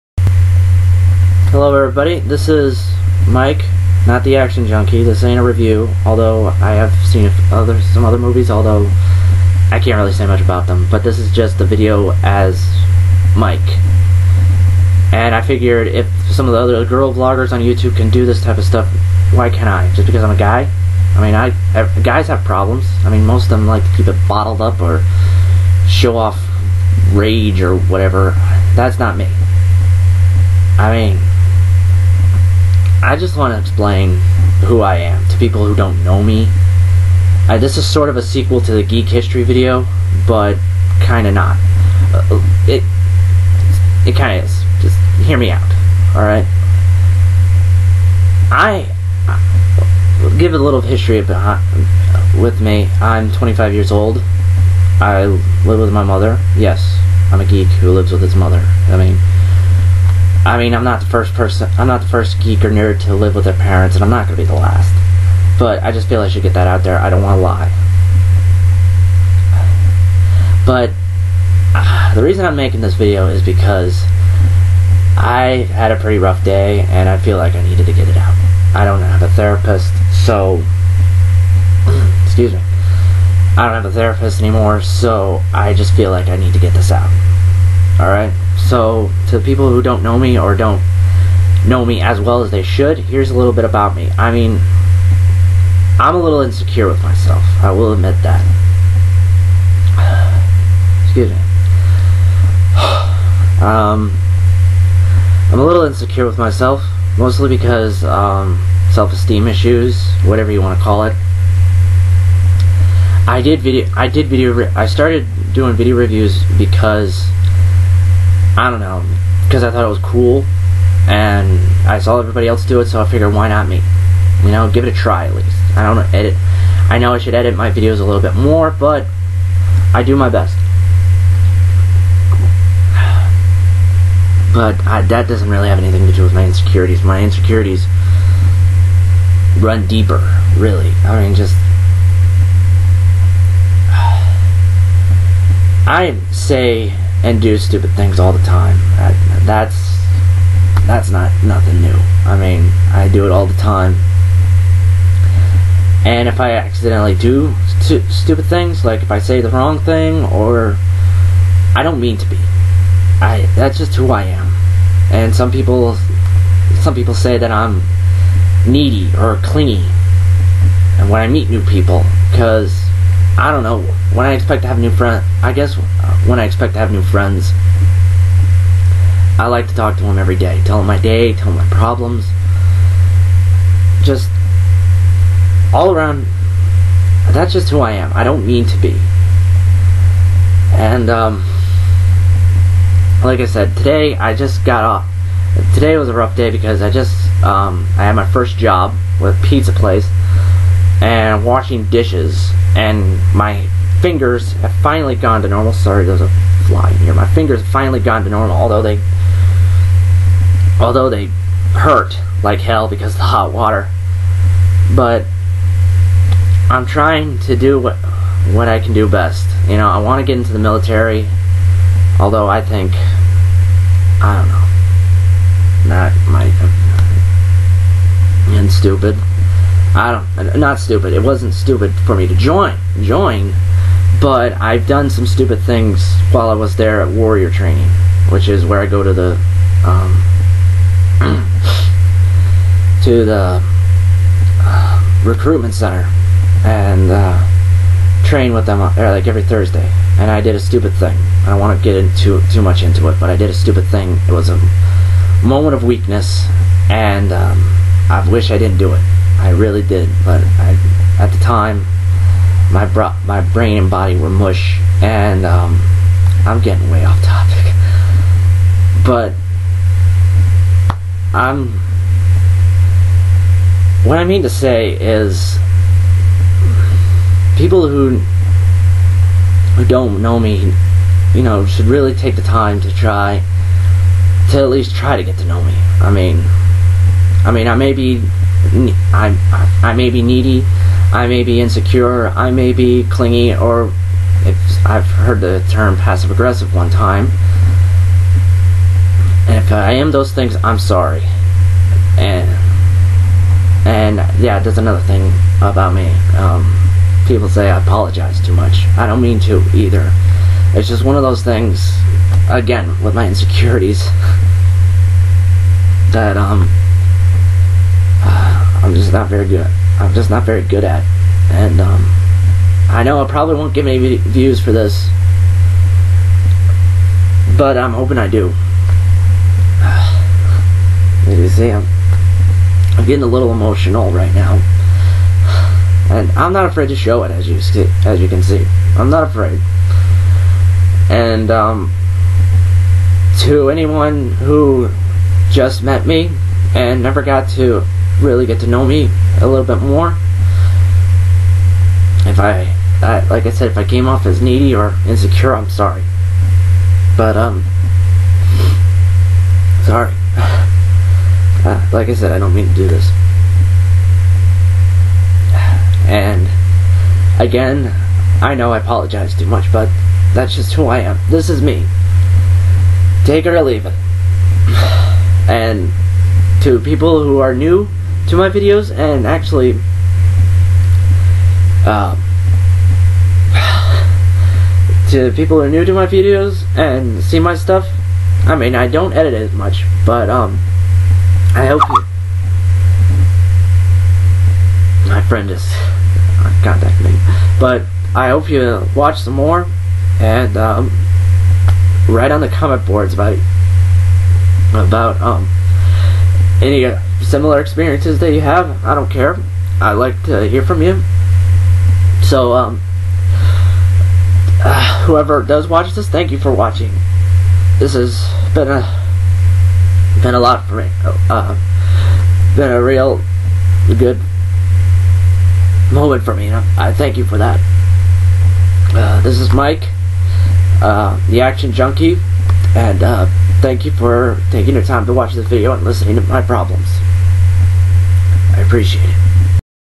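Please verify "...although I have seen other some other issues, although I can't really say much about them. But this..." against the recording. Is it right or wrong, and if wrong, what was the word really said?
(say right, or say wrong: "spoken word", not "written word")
wrong: "movies", not "issues".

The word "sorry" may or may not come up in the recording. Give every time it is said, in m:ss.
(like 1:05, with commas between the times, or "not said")
3:25, 5:00, 5:55, 5:59.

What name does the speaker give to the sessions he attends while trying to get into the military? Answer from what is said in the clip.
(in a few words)
warrior training.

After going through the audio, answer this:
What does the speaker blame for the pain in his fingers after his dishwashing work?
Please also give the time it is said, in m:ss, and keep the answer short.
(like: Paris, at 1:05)
hot water, at 3:33.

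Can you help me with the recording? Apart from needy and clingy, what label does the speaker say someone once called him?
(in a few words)
passive aggressive.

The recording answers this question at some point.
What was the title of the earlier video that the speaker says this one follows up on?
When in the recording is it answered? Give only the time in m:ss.
0:38.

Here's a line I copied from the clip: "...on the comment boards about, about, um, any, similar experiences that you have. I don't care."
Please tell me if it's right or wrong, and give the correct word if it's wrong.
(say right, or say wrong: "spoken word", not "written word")
right.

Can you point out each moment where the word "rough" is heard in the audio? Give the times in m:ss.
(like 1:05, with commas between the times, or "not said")
1:16, 3:16.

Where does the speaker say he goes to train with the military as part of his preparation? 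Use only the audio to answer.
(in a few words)
recruitment center.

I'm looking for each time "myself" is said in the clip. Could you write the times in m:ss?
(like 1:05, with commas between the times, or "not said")
1:37, 1:46.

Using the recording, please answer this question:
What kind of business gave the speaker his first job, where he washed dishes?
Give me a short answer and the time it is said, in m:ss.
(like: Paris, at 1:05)
pizza place, at 3:19.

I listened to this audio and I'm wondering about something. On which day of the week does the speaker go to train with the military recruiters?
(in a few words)
Thursday.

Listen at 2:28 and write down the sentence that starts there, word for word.
Uh, that's that's not nothing new.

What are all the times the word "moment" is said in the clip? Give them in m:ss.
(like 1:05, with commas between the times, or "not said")
4:15, 7:05.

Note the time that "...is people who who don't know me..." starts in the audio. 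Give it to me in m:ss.
4:34.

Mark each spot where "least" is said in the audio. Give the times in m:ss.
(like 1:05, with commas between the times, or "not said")
2:05, 4:44.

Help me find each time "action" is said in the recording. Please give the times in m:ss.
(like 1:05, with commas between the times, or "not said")
0:04, 7:11.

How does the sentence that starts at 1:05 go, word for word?
But I just feel I should get that out there.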